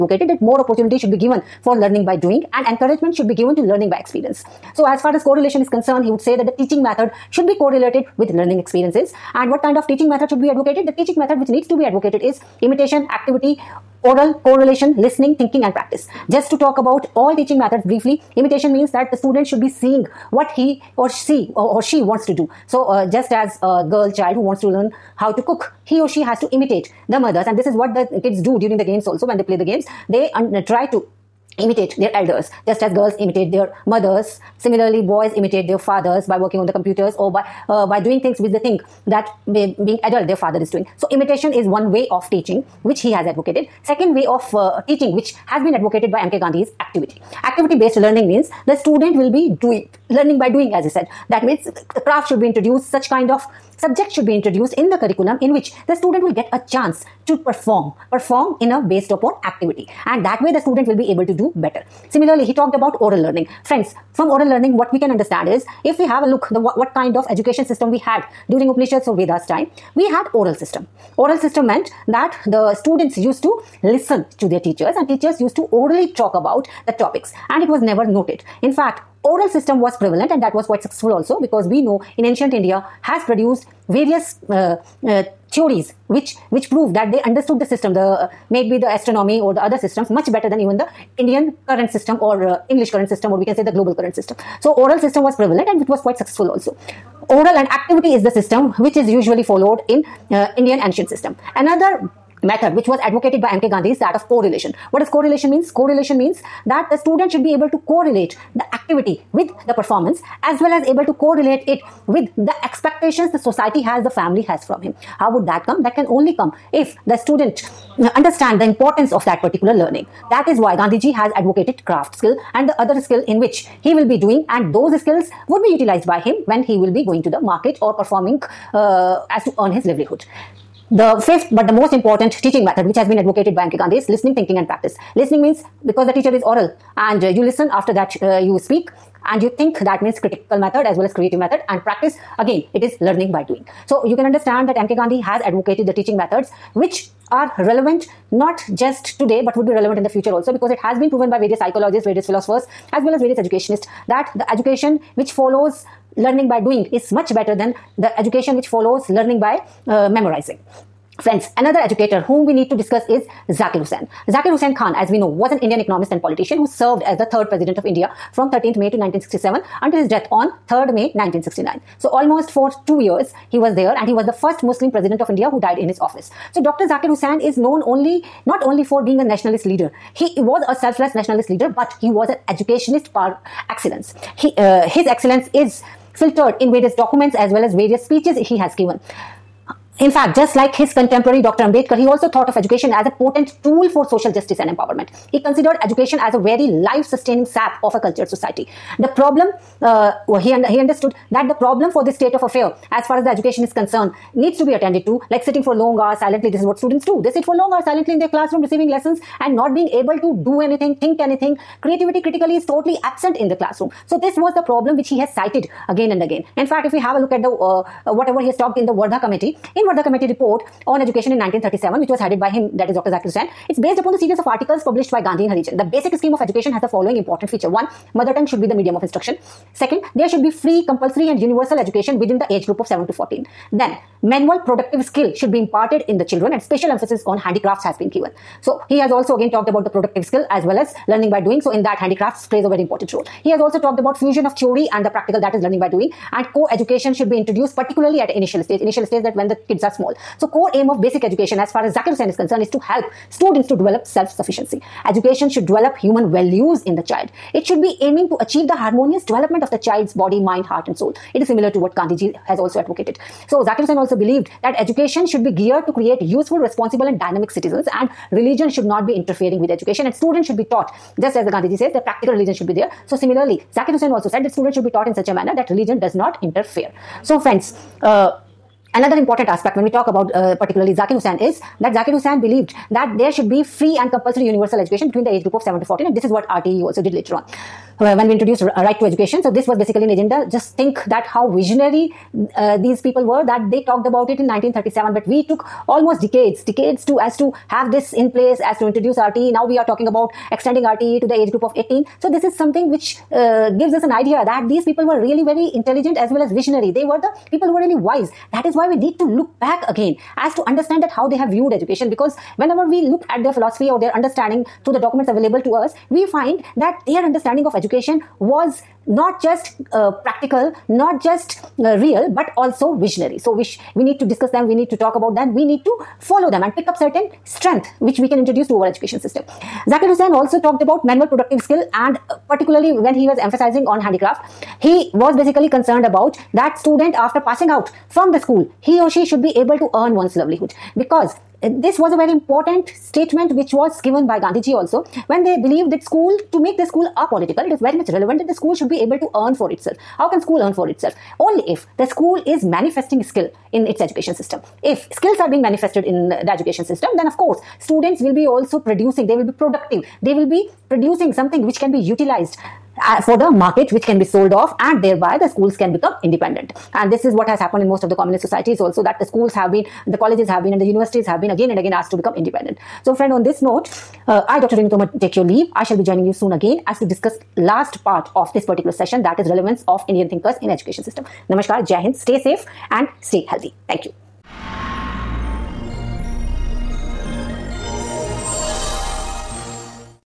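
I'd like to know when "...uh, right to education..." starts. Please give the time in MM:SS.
04:48.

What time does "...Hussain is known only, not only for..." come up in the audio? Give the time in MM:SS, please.
02:57.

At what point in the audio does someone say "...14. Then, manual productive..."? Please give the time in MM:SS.
03:53.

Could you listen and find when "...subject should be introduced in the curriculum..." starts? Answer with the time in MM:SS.
00:53.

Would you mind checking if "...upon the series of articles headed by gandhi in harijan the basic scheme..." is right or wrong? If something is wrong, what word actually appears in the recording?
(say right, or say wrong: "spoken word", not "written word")
wrong: "published", not "headed".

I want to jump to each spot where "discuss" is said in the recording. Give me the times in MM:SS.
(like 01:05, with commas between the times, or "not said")
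02:42, 05:24, 06:17.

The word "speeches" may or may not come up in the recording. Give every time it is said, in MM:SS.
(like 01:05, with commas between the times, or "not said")
03:08.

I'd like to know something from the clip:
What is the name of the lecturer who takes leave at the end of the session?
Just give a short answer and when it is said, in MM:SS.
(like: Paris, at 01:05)
Dr. Renu Tomar, at 06:14.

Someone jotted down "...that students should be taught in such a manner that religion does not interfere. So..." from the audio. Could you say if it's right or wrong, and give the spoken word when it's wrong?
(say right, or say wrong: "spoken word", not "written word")
right.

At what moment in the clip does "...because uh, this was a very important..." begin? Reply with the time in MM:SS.
05:40.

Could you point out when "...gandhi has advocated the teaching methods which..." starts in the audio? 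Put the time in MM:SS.
02:24.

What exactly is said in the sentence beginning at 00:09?
And what kind of teaching method should be advocated?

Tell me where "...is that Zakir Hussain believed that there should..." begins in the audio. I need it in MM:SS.
04:41.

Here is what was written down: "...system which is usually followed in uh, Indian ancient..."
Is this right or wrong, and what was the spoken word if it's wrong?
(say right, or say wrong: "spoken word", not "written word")
right.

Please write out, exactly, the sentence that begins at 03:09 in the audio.
In fact, just like his contemporary Dr.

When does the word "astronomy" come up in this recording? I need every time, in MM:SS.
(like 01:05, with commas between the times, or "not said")
01:28.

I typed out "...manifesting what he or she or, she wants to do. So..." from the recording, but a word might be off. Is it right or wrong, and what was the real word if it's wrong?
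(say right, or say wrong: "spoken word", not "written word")
wrong: "seeing", not "manifesting".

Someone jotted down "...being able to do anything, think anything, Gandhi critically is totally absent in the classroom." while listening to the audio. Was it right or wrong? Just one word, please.
wrong.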